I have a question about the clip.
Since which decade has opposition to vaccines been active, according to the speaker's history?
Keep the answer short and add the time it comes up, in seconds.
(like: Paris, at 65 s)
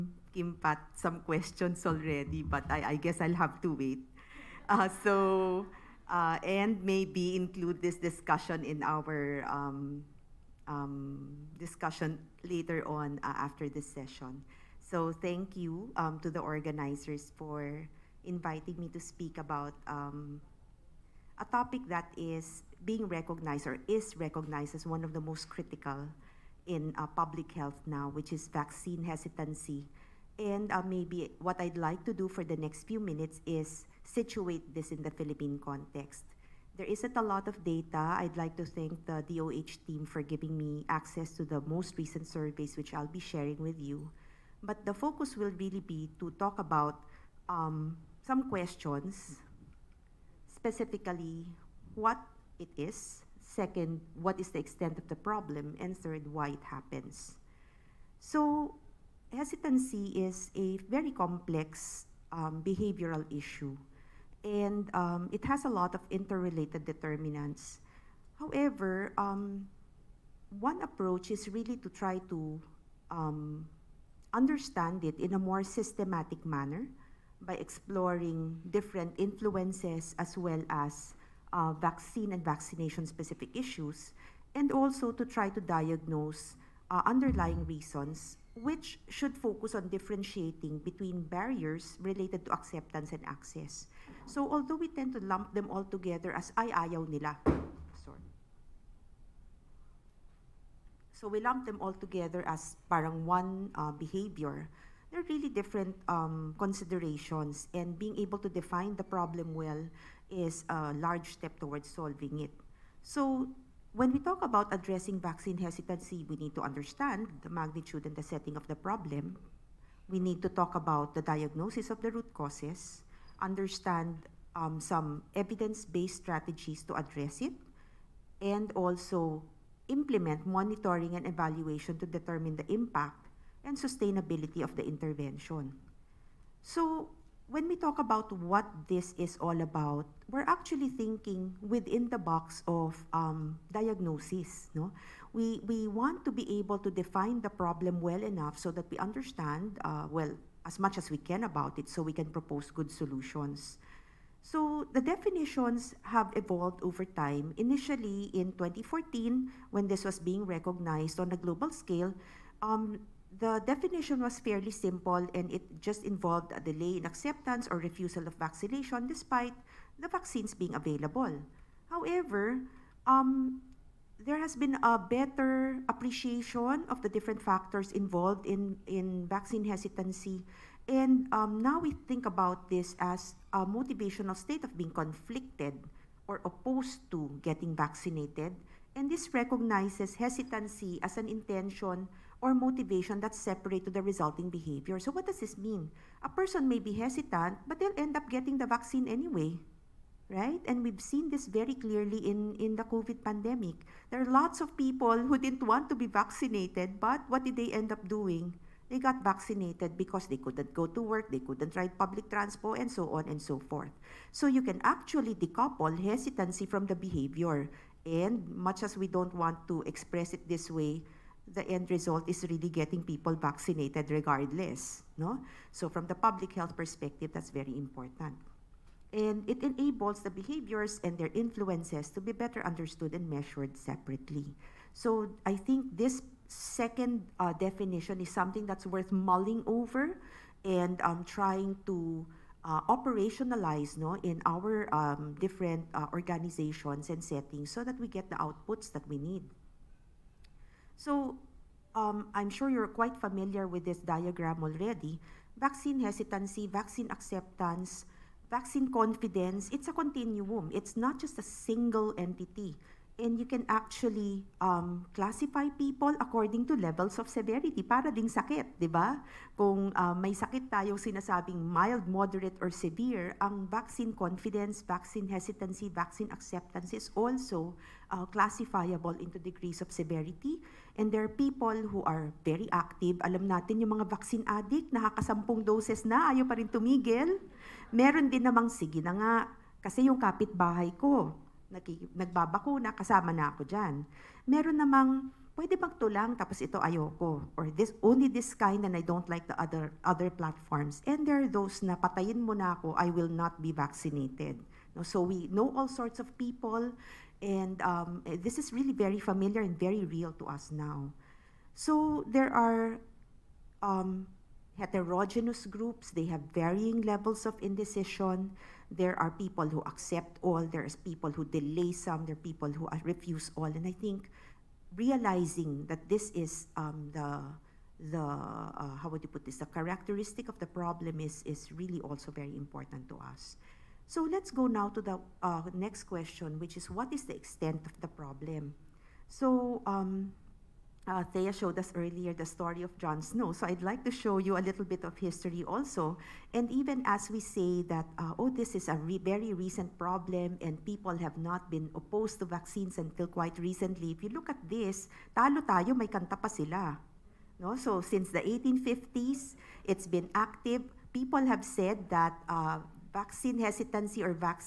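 1850s, at 358 s.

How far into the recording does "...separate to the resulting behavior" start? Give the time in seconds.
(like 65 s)
193 s.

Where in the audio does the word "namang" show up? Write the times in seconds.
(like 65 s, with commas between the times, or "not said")
288 s, 294 s.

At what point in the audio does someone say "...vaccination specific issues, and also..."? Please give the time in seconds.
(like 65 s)
82 s.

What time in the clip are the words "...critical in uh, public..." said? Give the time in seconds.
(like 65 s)
25 s.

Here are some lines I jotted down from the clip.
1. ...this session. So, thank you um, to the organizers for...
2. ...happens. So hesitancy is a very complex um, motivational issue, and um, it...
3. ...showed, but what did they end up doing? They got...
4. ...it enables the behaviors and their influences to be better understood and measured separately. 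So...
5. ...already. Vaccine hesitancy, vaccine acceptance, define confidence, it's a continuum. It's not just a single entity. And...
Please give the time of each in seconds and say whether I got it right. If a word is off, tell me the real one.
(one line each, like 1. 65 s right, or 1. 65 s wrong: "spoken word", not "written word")
1. 13 s right
2. 56 s wrong: "behavioral", not "motivational"
3. 206 s wrong: "vaccinated", not "showed"
4. 229 s right
5. 254 s wrong: "vaccine", not "define".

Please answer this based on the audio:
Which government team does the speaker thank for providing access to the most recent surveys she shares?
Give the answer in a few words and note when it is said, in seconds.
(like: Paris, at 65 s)
DOH team, at 39 s.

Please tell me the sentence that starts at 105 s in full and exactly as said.
They're really different um, considerations, and being able to define the problem well is a large step towards solving it.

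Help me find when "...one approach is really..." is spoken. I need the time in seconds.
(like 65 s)
70 s.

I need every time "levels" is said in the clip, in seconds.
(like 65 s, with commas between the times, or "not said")
266 s, 317 s.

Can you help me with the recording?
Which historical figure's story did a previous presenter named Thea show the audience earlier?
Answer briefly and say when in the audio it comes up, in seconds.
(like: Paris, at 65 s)
John Snow, at 342 s.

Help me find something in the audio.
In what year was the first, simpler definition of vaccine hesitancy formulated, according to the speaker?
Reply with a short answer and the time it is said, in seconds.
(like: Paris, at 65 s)
2014, at 158 s.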